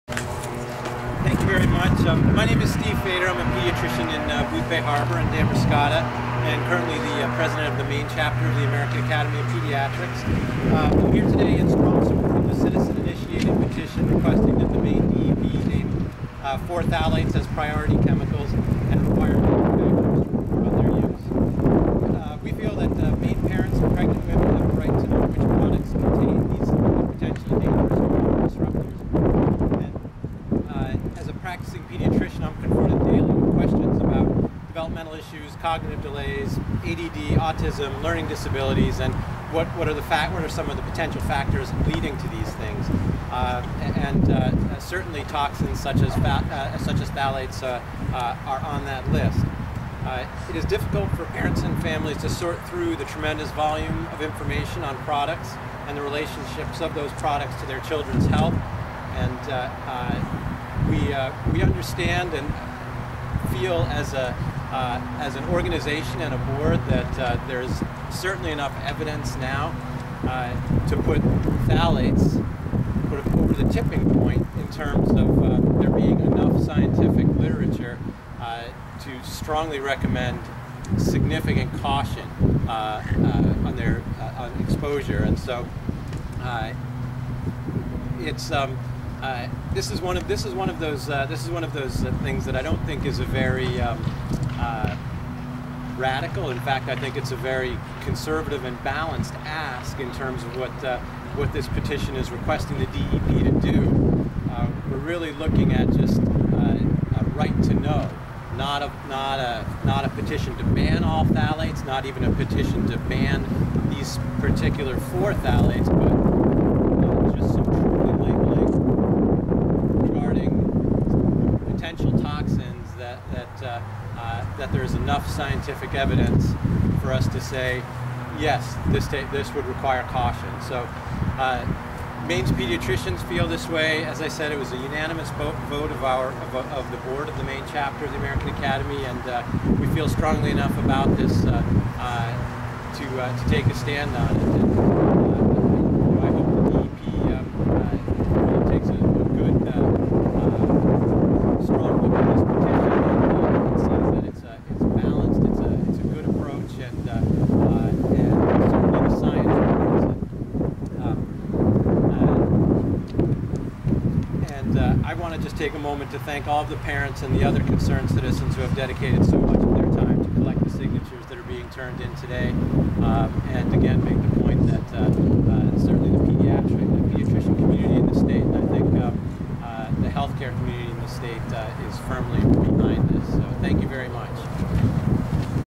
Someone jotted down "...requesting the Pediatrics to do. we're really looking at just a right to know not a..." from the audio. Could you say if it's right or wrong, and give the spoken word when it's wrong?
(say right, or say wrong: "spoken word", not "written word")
wrong: "DEP", not "Pediatrics".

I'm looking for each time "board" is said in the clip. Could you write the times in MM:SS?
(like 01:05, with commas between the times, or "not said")
01:06, 02:17.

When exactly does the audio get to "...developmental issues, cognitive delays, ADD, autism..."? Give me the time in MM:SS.
00:34.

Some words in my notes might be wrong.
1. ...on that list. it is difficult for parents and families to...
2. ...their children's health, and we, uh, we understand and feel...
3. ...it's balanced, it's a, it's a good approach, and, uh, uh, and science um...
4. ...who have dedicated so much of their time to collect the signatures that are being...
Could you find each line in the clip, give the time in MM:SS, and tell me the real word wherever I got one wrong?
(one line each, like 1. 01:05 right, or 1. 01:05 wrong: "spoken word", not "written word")
1. 00:48 right
2. 00:57 right
3. 02:34 right
4. 02:48 right.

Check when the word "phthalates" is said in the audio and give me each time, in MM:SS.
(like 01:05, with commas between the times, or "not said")
00:16, 00:47, 01:11, 01:51, 01:55.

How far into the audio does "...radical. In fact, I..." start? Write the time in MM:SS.
01:35.